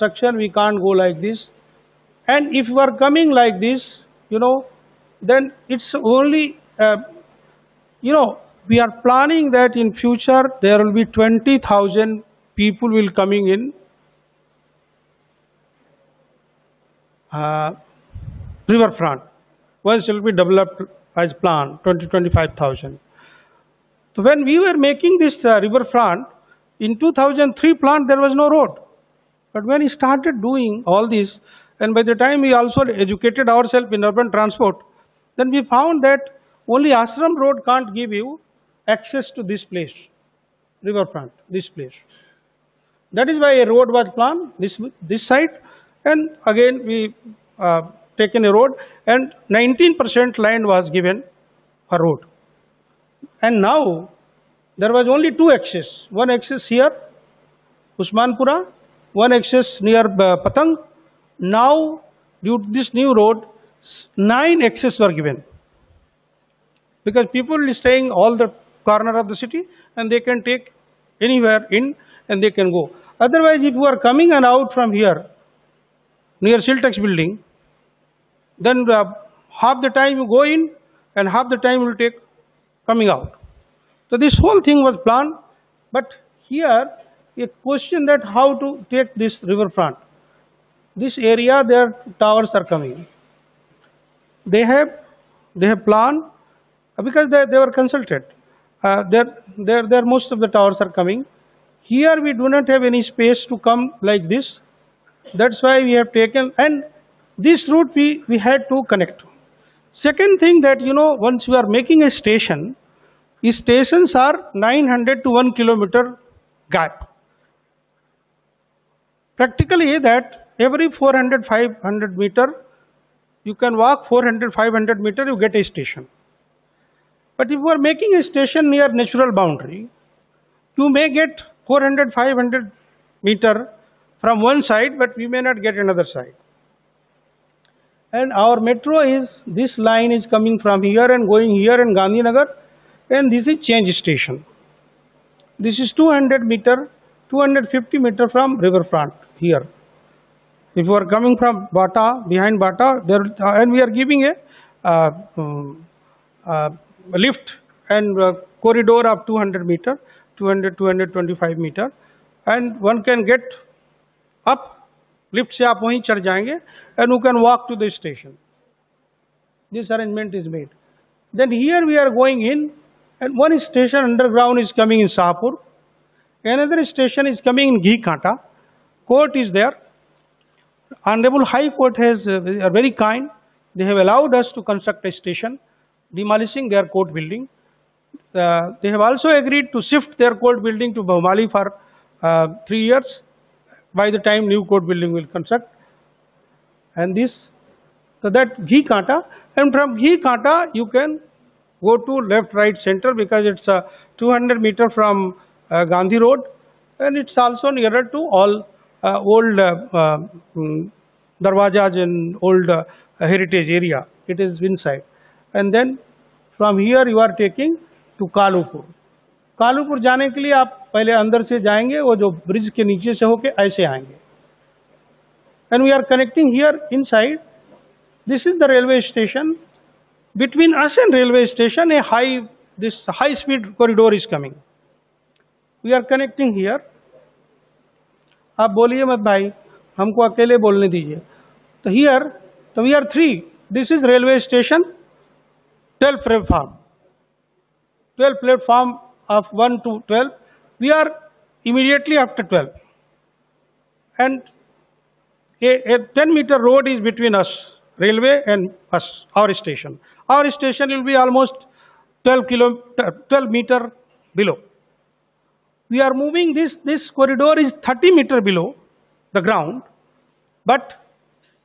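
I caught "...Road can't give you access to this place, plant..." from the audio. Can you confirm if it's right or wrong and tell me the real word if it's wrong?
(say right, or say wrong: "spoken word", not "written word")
wrong: "riverfront", not "plant".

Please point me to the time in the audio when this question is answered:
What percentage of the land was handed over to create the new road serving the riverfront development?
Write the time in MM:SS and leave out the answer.
00:49.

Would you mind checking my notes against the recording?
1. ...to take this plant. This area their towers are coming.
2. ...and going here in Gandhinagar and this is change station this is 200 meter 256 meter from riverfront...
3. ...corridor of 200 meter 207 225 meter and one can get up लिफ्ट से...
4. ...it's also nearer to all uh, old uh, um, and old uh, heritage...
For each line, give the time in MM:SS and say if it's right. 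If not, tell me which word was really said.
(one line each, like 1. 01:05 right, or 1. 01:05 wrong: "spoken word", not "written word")
1. 01:28 wrong: "riverfront", not "plant"
2. 02:21 wrong: "250", not "256"
3. 02:38 wrong: "200", not "207"
4. 03:27 right.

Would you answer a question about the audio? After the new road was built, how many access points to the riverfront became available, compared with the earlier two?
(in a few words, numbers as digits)
9.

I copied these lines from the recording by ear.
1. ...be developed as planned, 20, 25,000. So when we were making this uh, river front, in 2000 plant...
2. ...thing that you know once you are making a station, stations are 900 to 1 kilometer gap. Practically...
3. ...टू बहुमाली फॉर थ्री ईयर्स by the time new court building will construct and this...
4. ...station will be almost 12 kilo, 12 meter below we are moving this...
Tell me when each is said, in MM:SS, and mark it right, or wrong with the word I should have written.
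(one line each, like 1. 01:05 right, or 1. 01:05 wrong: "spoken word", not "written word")
1. 00:20 wrong: "2003", not "2000"
2. 01:50 right
3. 03:10 right
4. 04:20 right.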